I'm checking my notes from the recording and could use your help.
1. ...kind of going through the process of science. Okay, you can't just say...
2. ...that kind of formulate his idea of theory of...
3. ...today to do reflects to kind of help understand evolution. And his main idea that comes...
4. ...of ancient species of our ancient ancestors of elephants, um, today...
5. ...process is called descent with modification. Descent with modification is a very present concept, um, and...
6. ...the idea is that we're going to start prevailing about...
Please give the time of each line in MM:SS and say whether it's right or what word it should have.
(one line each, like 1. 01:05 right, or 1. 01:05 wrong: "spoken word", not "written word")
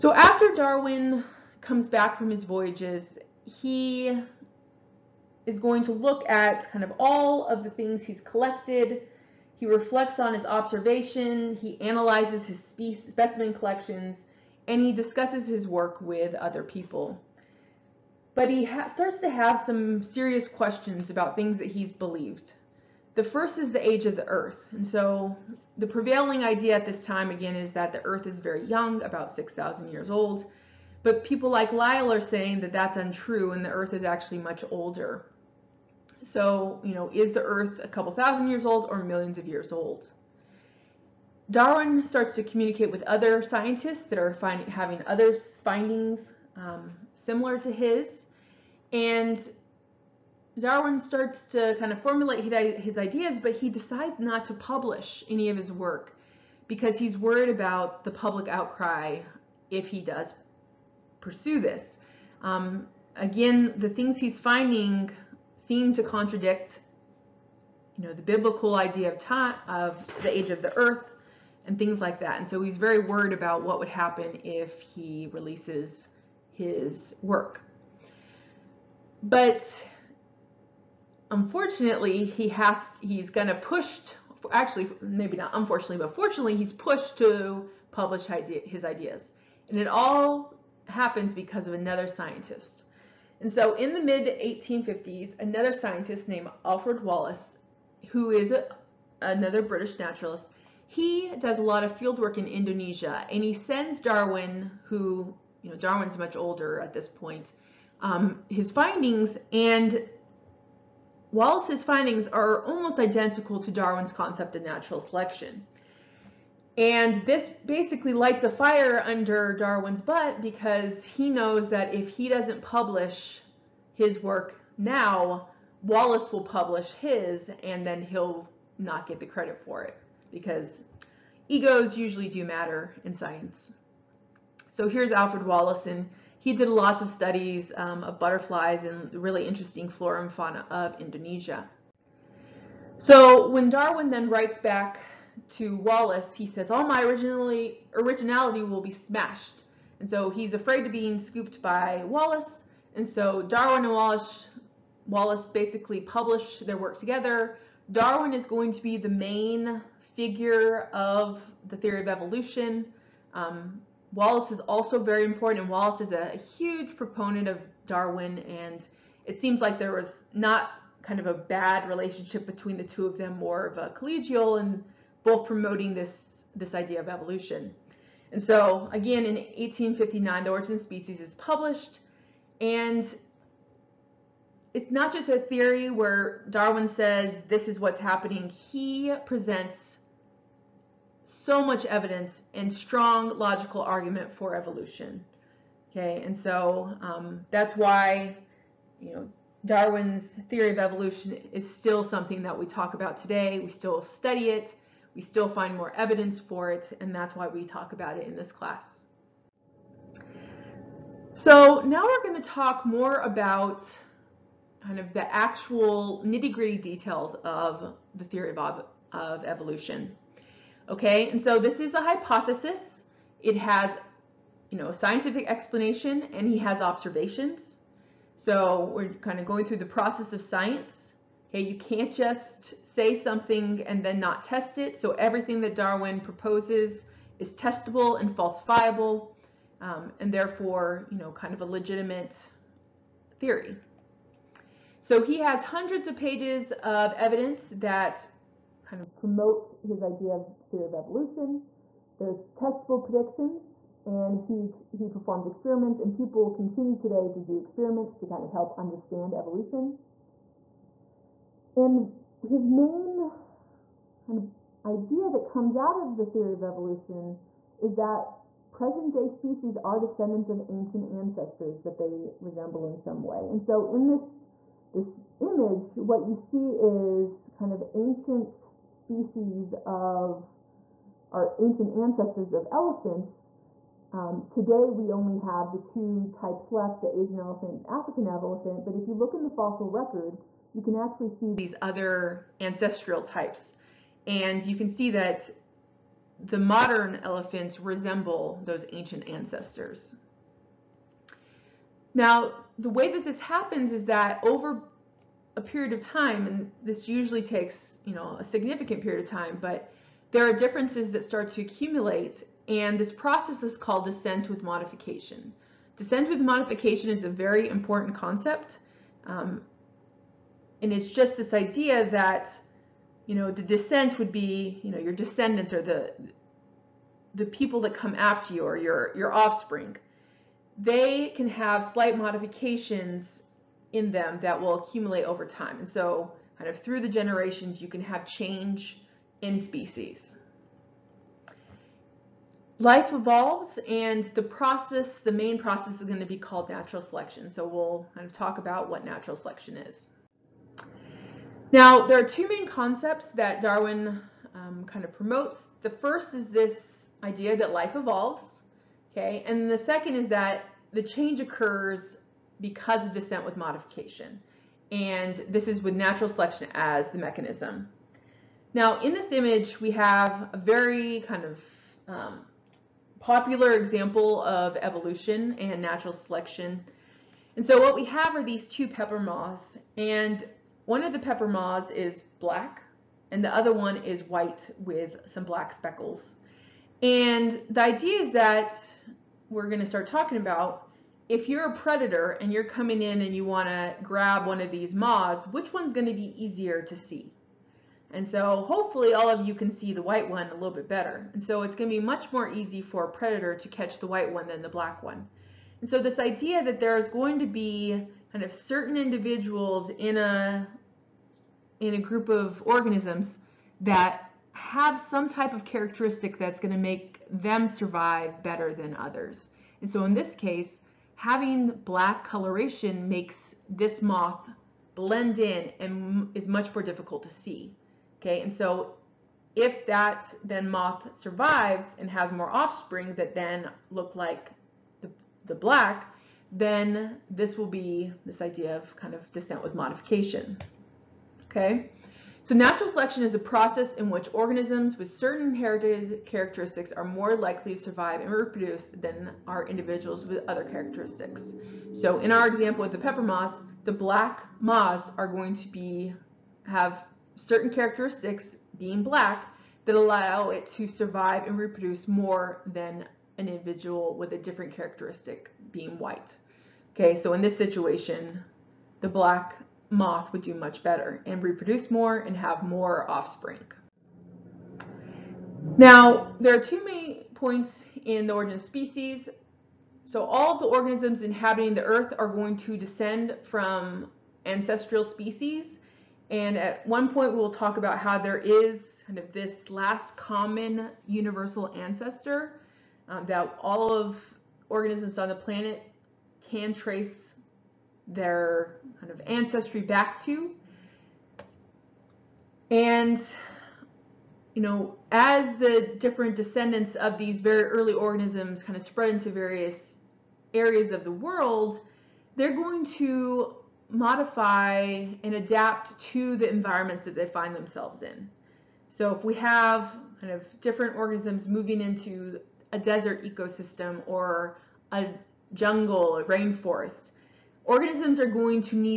1. 03:49 right
2. 04:07 wrong: "promote", not "formulate"
3. 04:16 wrong: "experiments", not "reflects"
4. 04:37 right
5. 05:13 wrong: "important", not "present"
6. 06:27 wrong: "talking", not "prevailing".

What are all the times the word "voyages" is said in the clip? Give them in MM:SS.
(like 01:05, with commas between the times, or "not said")
00:02.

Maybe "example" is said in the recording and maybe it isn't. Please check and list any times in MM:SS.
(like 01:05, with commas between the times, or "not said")
06:13, 07:32.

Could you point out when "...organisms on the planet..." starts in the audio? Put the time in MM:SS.
08:14.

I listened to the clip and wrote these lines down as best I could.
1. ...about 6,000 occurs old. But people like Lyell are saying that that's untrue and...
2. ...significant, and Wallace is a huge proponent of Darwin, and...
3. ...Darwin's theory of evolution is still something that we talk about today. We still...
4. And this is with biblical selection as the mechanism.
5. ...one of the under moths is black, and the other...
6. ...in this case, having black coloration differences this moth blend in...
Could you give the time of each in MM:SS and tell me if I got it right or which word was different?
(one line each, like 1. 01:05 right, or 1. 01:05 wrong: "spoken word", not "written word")
1. 00:29 wrong: "years", not "occurs"
2. 02:45 wrong: "important", not "significant"
3. 03:19 right
4. 06:04 wrong: "natural", not "biblical"
5. 06:20 wrong: "pepper", not "under"
6. 07:00 wrong: "makes", not "differences".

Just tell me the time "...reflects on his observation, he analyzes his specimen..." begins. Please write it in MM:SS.
00:09.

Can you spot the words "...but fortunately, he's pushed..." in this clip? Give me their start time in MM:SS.
01:25.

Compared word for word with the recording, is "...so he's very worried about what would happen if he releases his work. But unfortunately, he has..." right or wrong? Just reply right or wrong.
right.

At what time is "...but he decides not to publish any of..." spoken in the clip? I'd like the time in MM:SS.
00:53.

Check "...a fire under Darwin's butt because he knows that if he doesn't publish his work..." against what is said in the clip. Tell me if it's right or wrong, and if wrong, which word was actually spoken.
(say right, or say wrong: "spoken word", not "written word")
right.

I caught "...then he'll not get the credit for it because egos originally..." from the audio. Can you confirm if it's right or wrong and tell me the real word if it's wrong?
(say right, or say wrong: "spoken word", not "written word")
wrong: "usually", not "originally".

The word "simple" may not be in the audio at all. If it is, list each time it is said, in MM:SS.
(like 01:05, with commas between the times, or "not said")
not said.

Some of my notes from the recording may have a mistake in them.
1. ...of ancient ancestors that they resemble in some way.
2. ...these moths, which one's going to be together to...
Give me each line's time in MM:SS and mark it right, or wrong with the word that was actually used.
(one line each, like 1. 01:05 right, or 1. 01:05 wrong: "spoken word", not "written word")
1. 04:30 right
2. 06:34 wrong: "easier", not "together".